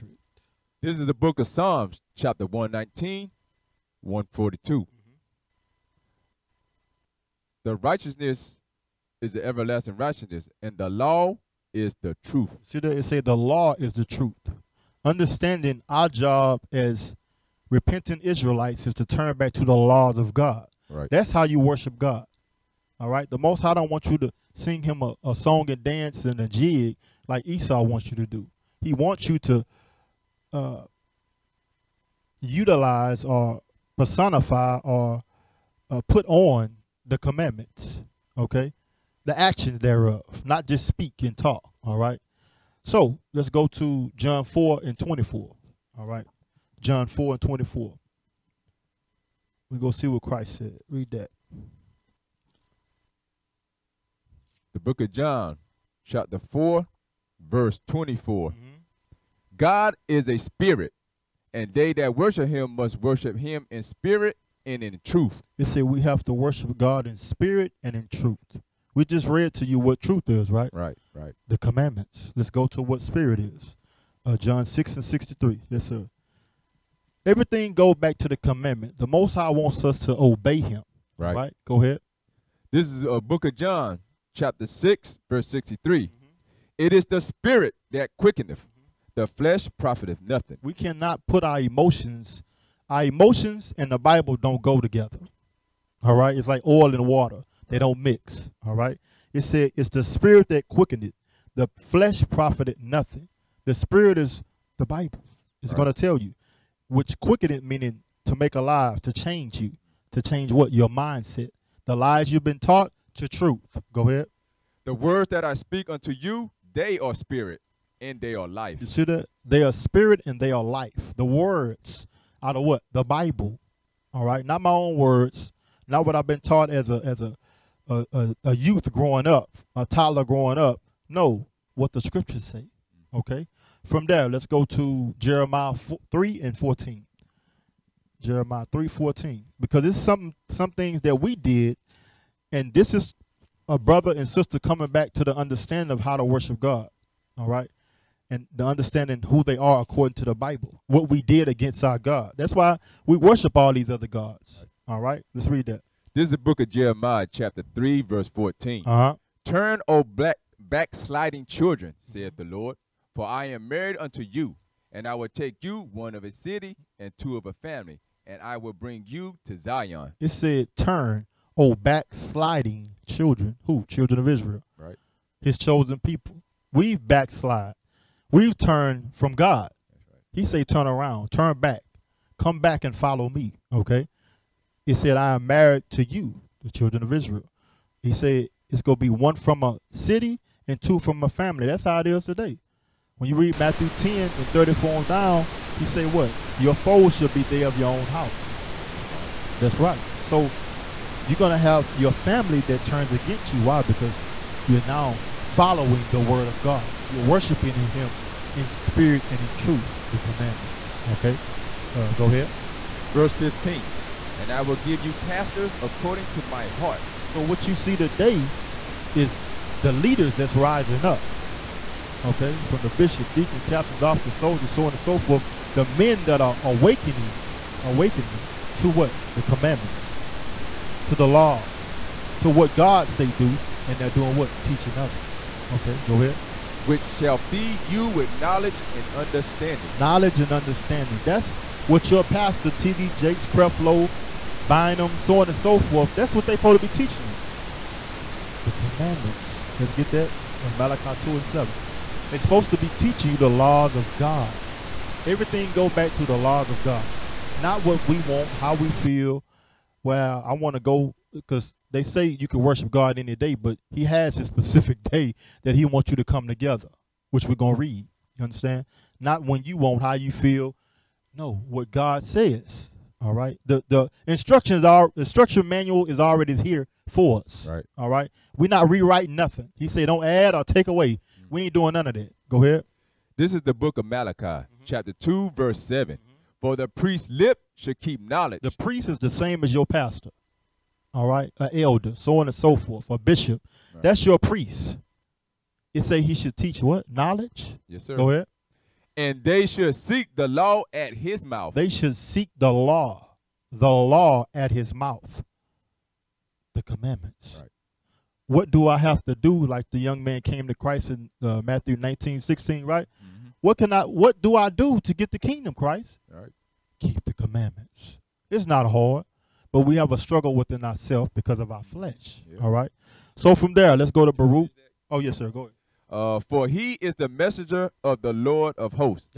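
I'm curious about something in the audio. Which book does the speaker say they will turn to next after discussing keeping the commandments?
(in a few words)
Baruch.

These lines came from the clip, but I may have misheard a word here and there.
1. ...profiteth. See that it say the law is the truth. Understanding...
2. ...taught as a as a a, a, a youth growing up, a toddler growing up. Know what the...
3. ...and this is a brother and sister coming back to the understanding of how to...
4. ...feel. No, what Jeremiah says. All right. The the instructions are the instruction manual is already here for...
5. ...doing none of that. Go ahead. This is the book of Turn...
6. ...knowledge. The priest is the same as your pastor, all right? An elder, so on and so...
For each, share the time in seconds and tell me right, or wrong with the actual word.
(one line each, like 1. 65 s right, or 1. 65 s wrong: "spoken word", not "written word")
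1. 12 s wrong: "truth", not "profiteth"
2. 126 s right
3. 142 s right
4. 270 s wrong: "God", not "Jeremiah"
5. 281 s wrong: "Malachi", not "Turn"
6. 288 s right.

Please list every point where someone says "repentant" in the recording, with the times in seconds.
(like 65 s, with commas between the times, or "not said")
17 s.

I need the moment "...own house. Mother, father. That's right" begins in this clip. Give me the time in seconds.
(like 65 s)
197 s.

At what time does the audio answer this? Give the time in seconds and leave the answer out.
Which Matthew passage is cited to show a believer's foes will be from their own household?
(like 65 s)
193 s.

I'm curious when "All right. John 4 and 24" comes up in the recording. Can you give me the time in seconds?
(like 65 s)
45 s.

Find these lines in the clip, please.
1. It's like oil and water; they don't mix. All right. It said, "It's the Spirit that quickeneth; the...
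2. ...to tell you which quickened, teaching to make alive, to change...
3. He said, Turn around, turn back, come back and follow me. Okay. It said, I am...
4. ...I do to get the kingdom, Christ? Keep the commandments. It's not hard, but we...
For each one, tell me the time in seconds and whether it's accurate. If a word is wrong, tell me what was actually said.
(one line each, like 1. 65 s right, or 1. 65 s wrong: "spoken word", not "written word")
1. 96 s right
2. 105 s wrong: "meaning", not "teaching"
3. 180 s right
4. 314 s right.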